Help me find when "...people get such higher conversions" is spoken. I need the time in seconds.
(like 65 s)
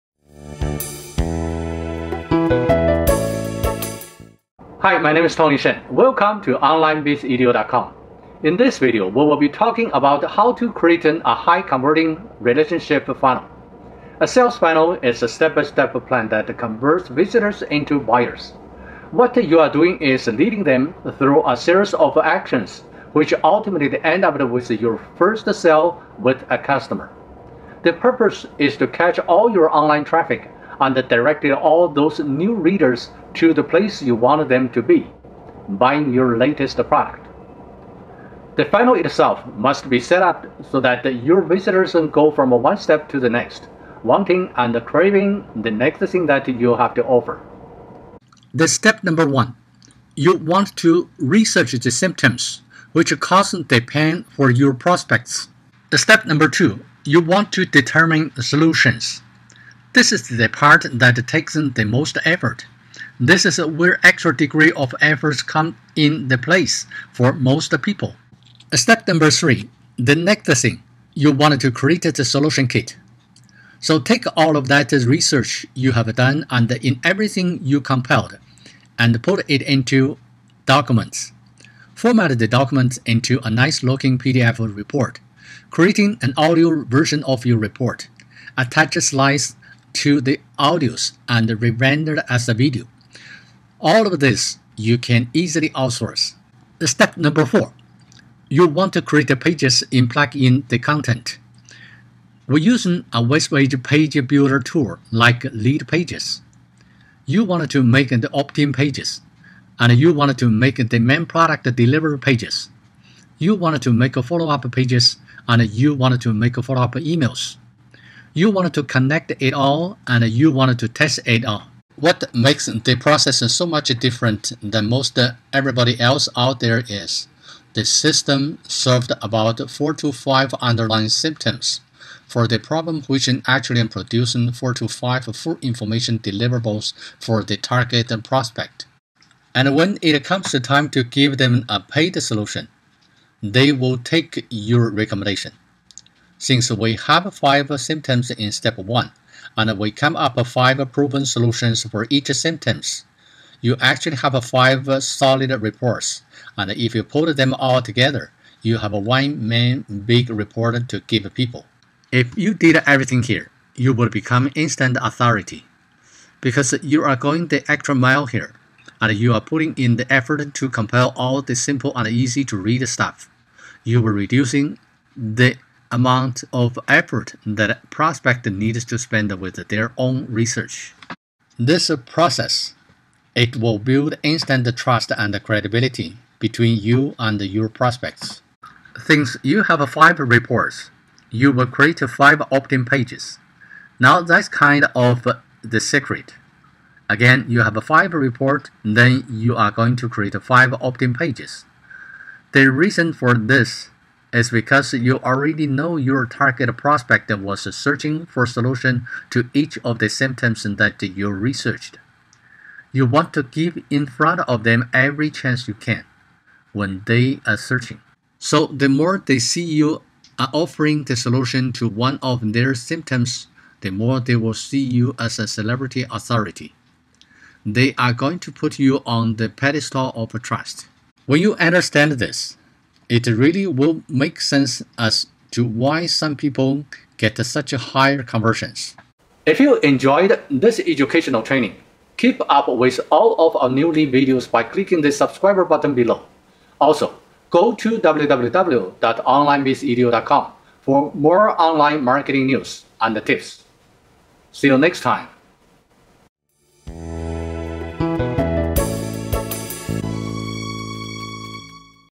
236 s.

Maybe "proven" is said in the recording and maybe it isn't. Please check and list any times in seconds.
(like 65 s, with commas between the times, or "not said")
150 s.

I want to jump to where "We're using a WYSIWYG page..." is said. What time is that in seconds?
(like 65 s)
102 s.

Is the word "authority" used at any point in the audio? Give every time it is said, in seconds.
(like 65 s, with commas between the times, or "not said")
164 s, 226 s.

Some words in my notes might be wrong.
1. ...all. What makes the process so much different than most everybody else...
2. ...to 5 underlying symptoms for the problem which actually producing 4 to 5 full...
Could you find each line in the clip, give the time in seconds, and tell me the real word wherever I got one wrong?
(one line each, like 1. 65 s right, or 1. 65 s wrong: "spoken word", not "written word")
1. 121 s right
2. 129 s right.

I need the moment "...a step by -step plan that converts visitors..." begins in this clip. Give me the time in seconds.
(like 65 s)
15 s.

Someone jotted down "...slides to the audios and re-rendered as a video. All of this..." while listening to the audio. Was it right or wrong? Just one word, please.
right.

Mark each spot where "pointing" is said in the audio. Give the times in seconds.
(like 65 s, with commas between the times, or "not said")
not said.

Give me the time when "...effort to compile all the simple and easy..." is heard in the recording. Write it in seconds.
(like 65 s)
170 s.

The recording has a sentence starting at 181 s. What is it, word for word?
This process, it will build instant trust and credibility between you and your prospects.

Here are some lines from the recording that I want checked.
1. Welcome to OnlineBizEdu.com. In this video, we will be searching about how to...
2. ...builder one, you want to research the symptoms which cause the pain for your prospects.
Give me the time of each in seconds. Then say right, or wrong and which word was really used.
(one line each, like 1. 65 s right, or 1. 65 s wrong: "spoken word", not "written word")
1. 5 s wrong: "talking", not "searching"
2. 49 s wrong: "number", not "builder".